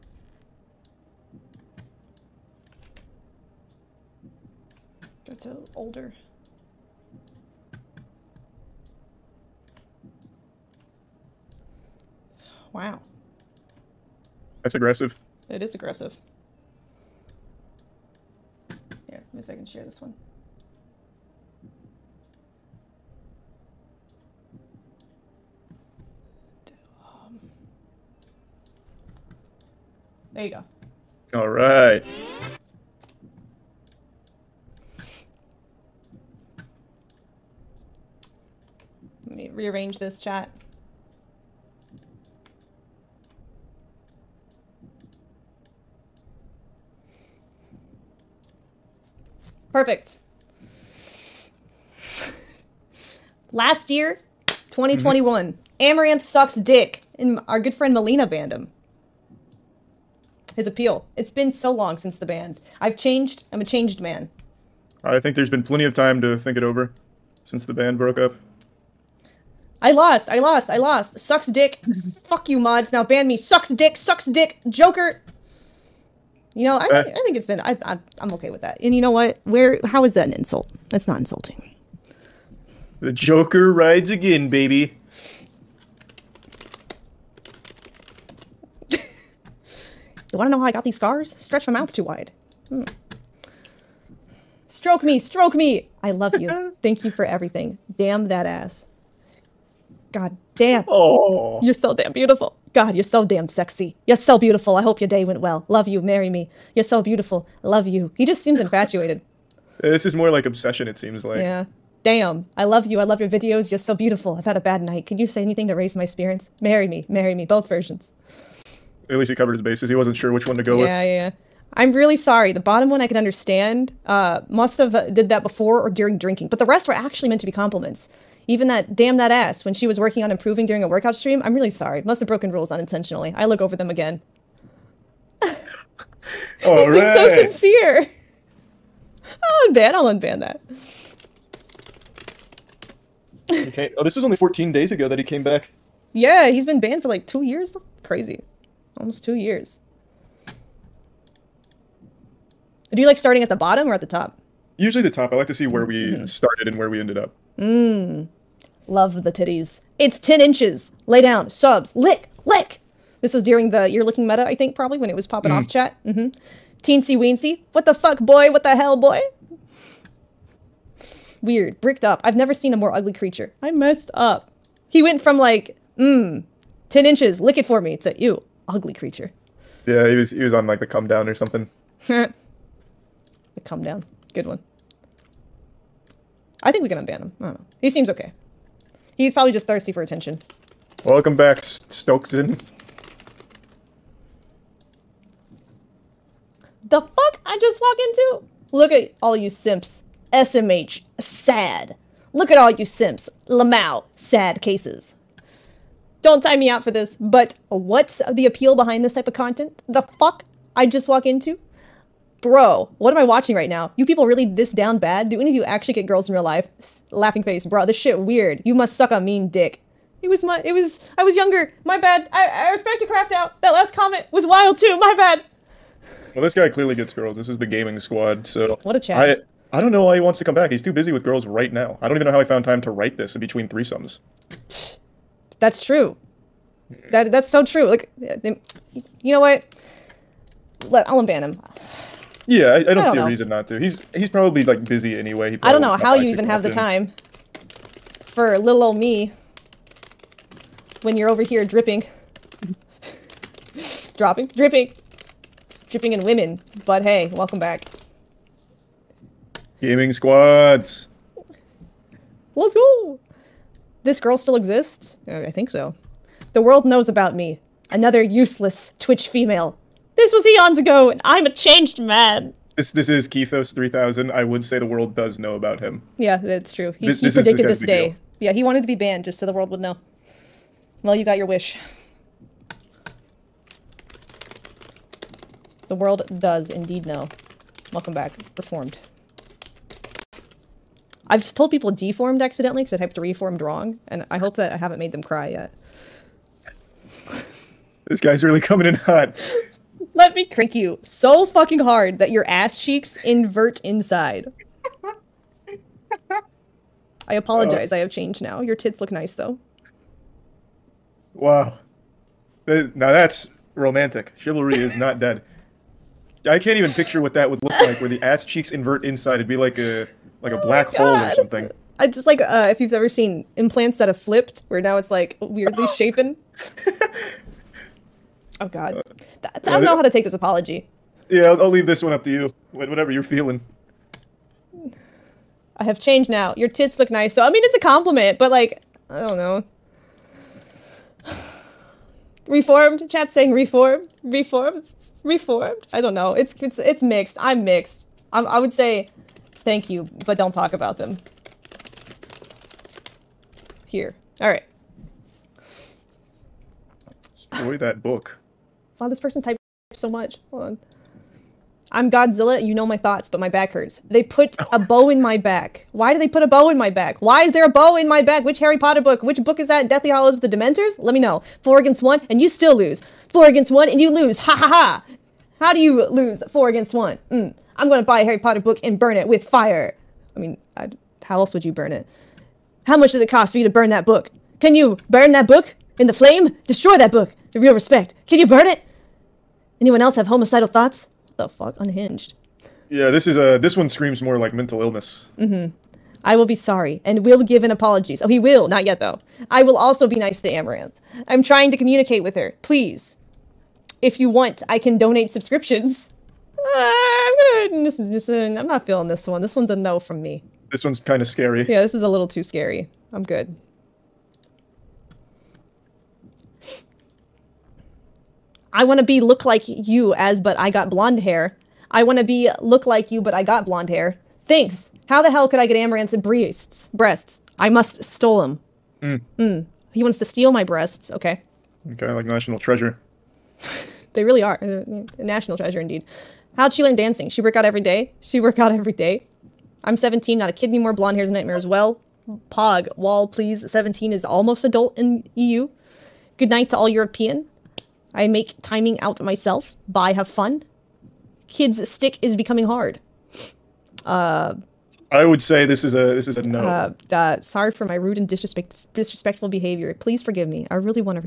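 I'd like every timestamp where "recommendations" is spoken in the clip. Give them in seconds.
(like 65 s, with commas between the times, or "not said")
not said.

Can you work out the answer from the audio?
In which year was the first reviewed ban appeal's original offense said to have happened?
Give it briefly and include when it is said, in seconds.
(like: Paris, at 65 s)
2021, at 54 s.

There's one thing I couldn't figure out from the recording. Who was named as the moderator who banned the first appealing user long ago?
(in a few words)
Melina.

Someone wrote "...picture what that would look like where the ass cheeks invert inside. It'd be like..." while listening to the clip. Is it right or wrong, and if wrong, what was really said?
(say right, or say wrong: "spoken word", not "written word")
right.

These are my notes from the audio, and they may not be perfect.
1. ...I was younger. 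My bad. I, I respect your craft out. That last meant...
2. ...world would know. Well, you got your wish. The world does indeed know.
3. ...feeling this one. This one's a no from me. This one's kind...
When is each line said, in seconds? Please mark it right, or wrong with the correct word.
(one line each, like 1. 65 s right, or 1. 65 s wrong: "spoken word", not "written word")
1. 221 s wrong: "comment", not "meant"
2. 279 s right
3. 408 s right.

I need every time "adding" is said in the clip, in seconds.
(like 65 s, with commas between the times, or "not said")
not said.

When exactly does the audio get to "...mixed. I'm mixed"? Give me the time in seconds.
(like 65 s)
347 s.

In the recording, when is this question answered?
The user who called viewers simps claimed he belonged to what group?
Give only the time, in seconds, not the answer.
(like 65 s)
227 s.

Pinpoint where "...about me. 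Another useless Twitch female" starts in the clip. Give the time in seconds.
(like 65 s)
267 s.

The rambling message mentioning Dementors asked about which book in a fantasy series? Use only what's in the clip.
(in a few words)
Deathly Hallows.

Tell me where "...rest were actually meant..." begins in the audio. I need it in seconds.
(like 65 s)
126 s.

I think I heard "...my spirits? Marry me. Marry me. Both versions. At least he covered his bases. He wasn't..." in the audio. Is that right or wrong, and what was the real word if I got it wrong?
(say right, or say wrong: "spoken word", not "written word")
right.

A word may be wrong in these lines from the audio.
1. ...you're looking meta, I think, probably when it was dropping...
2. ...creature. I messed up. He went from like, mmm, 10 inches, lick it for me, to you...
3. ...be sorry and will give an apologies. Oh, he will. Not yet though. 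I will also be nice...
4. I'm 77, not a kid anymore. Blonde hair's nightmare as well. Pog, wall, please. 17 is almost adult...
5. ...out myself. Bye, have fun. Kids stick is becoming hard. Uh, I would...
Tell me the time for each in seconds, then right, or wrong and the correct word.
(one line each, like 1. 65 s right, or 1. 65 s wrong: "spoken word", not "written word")
1. 163 s wrong: "popping", not "dropping"
2. 173 s right
3. 396 s right
4. 439 s wrong: "17", not "77"
5. 448 s right.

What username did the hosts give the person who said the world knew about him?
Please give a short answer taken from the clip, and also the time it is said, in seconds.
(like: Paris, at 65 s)
Kethos 3000, at 273 s.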